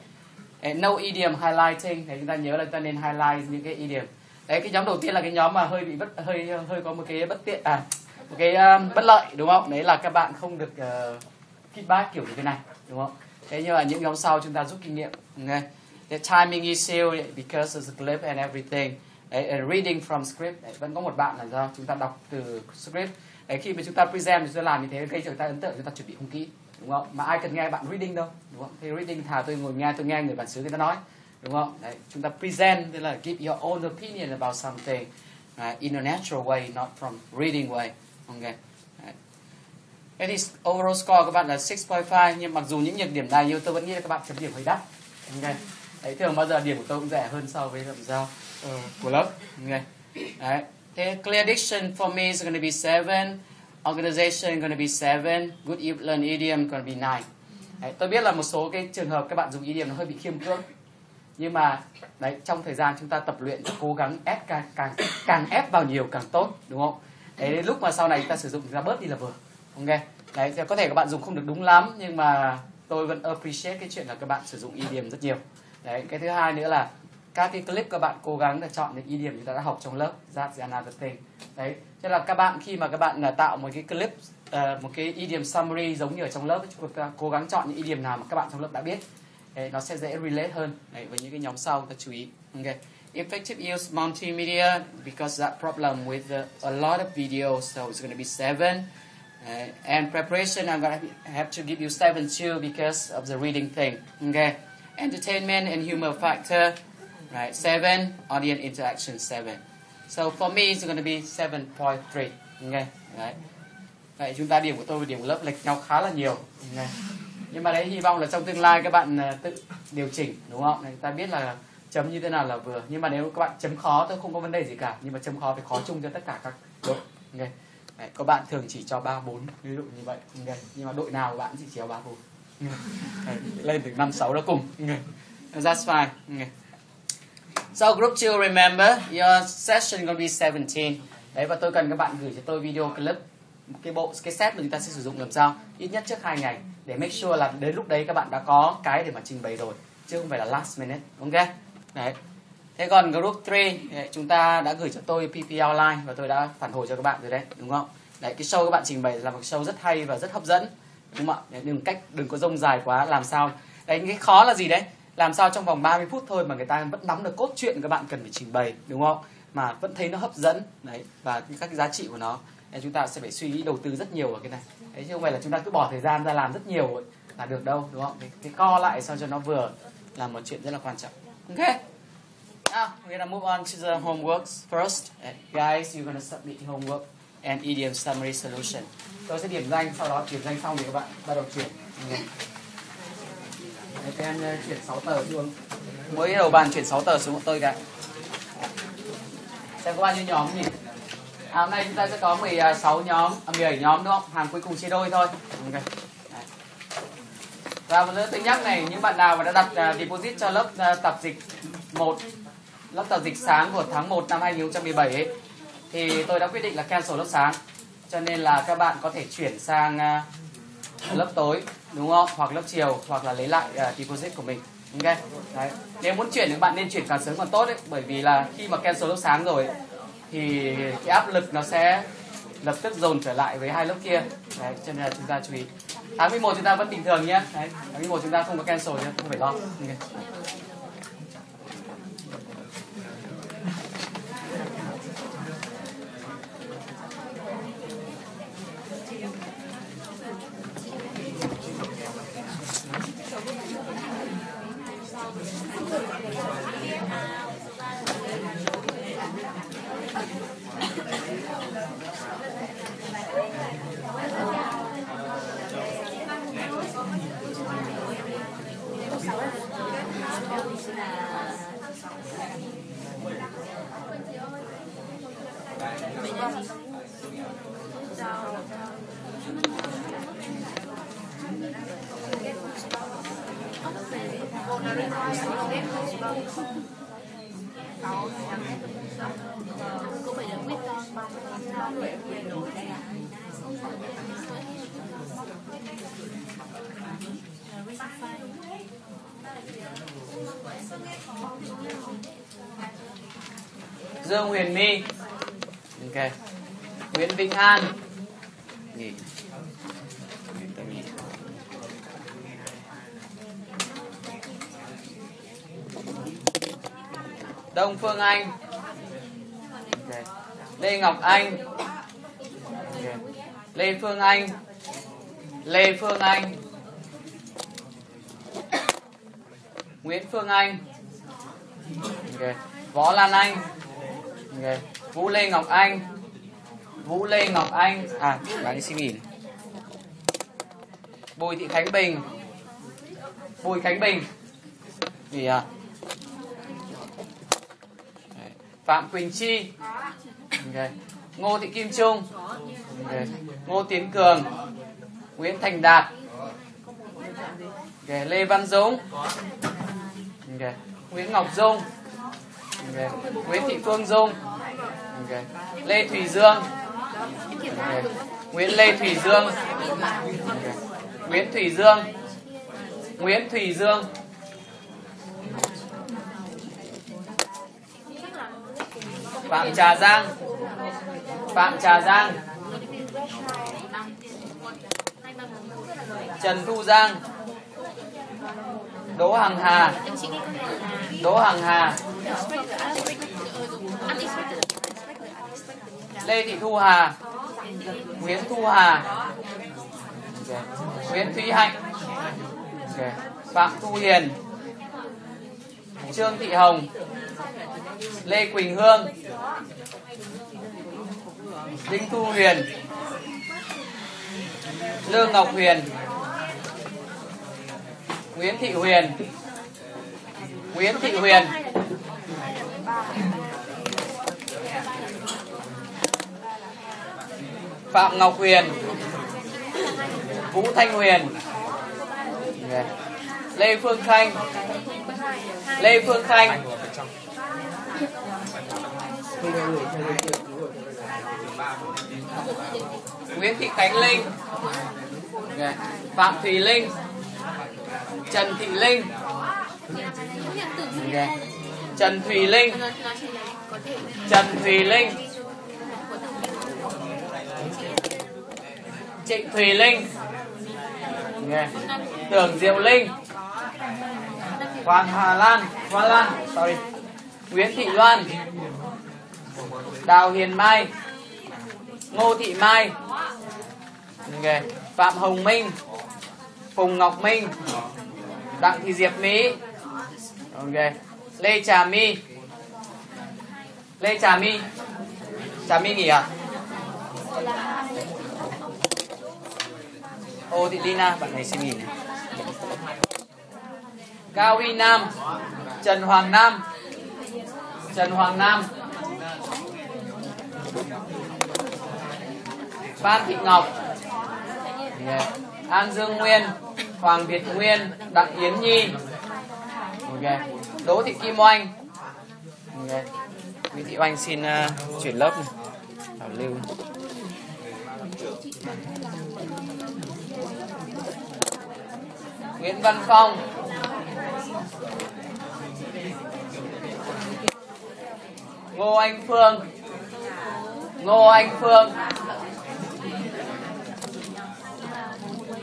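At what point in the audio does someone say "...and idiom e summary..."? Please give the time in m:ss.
3:07.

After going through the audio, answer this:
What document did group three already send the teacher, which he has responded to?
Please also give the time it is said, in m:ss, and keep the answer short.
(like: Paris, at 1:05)
PP outline, at 2:35.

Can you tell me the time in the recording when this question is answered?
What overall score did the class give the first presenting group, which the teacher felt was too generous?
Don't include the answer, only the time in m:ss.
0:41.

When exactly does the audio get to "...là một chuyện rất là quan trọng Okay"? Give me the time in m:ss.
3:00.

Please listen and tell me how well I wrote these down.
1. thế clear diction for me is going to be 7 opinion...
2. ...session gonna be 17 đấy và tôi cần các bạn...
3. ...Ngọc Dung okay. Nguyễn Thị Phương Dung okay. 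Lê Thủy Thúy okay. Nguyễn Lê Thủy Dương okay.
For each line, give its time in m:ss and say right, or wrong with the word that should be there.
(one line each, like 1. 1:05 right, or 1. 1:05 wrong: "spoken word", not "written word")
1. 0:50 wrong: "organization", not "opinion"
2. 2:19 right
3. 6:01 wrong: "Dương", not "Thúy".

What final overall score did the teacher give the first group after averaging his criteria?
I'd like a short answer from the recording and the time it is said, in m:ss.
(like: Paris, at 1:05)
7.3, at 1:51.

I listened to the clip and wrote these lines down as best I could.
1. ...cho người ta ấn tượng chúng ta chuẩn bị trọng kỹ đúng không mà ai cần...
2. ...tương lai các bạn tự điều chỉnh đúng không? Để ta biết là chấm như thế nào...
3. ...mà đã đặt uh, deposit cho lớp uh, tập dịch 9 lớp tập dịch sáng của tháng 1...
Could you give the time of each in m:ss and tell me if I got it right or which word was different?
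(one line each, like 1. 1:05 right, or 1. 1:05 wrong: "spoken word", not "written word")
1. 0:25 wrong: "không", not "trọng"
2. 1:58 right
3. 3:29 wrong: "1", not "9".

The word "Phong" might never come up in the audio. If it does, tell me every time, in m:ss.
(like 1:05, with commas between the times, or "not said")
8:43.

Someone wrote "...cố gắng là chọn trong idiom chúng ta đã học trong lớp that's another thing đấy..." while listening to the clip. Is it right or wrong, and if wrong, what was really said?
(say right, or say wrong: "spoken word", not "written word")
wrong: "những", not "trong".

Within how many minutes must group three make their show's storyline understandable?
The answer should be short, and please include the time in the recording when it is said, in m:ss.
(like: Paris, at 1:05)
30, at 2:45.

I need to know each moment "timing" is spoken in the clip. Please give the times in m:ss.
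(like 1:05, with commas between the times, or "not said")
0:16.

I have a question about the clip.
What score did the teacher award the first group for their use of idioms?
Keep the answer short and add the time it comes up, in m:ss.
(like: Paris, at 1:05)
9, at 0:56.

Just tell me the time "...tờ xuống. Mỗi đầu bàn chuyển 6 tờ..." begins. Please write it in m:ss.
3:14.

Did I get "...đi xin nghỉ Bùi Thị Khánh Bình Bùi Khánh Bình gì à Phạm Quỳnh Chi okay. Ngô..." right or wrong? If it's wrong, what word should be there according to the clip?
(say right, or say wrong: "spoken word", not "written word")
right.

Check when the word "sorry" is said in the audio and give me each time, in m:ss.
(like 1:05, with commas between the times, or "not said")
7:46.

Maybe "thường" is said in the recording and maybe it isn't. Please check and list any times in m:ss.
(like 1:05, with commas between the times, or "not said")
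0:46, 2:08, 3:57.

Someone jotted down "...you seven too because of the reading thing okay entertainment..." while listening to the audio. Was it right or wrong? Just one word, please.
right.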